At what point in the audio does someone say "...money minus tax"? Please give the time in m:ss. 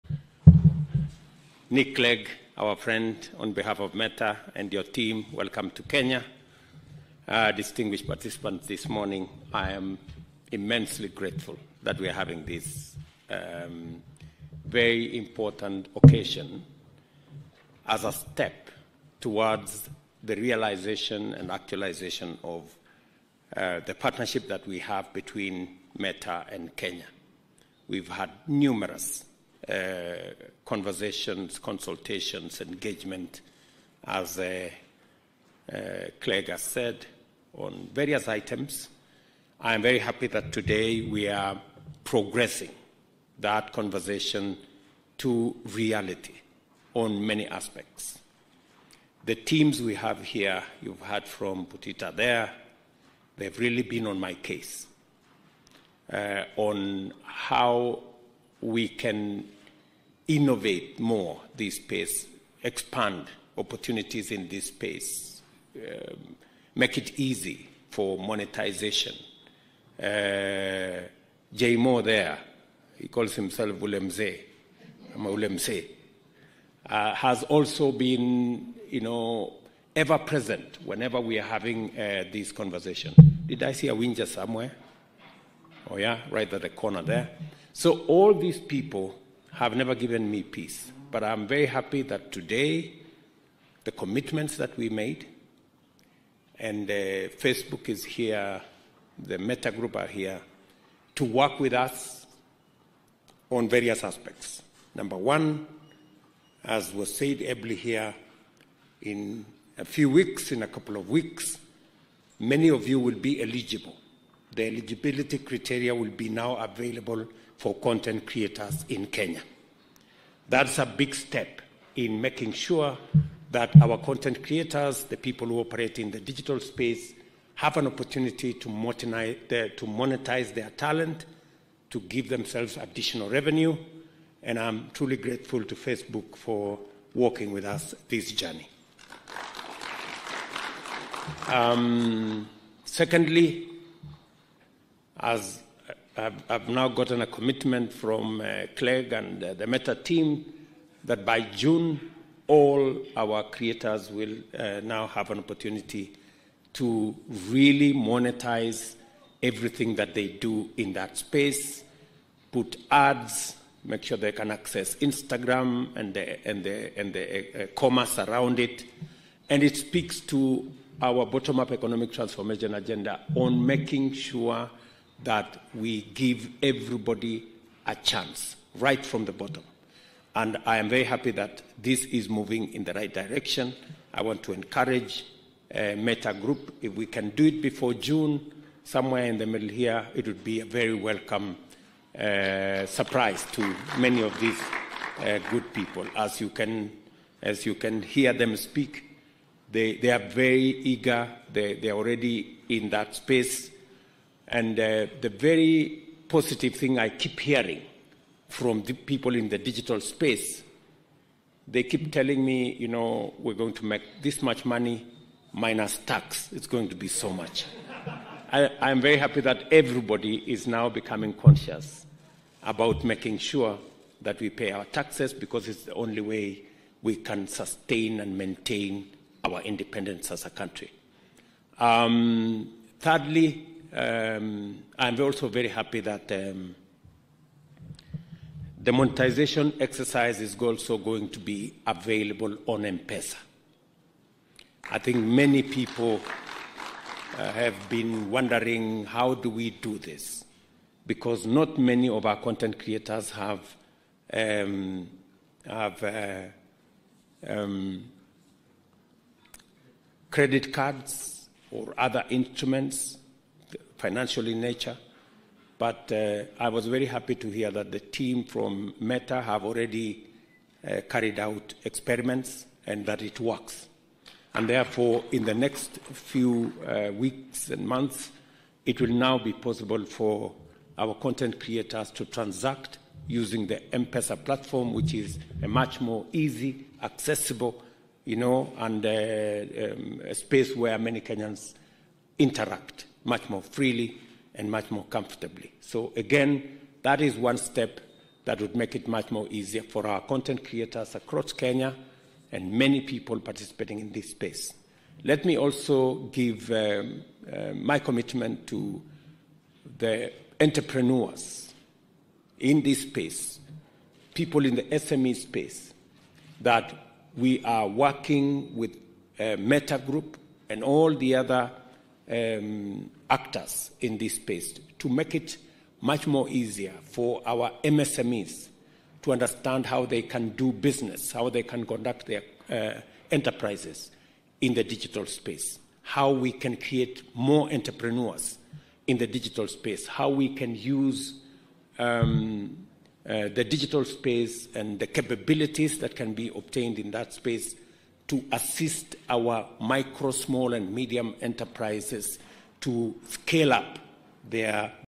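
3:34.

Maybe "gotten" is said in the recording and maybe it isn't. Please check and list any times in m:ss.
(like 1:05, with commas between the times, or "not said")
2:26.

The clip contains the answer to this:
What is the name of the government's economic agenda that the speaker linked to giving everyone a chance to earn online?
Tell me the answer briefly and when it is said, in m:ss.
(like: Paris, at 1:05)
bottom up economic transformation, at 2:51.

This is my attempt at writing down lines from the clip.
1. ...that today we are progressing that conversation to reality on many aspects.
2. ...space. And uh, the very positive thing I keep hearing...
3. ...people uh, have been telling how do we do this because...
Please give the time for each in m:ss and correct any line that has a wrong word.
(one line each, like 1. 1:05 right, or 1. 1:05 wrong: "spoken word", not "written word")
1. 0:40 right
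2. 3:23 right
3. 4:05 wrong: "wondering", not "telling".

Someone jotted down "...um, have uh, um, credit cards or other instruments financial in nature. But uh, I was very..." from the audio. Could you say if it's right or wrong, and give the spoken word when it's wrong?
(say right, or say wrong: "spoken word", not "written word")
right.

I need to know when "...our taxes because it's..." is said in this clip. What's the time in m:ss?
3:44.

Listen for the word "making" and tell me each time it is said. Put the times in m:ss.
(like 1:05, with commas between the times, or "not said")
2:02, 2:53, 3:43.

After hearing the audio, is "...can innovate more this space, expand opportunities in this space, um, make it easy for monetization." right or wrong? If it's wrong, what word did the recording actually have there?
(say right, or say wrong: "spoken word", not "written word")
right.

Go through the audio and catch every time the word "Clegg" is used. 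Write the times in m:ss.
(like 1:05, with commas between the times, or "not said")
0:01, 0:36, 2:28.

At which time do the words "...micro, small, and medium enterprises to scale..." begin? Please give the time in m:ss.
5:49.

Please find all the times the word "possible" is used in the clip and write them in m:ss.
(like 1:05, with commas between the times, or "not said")
4:39.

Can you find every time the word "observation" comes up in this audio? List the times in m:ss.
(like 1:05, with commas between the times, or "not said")
not said.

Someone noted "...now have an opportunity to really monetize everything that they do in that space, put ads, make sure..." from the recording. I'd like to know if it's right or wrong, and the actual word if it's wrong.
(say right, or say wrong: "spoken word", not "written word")
right.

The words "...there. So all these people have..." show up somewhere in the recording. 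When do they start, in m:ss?
1:27.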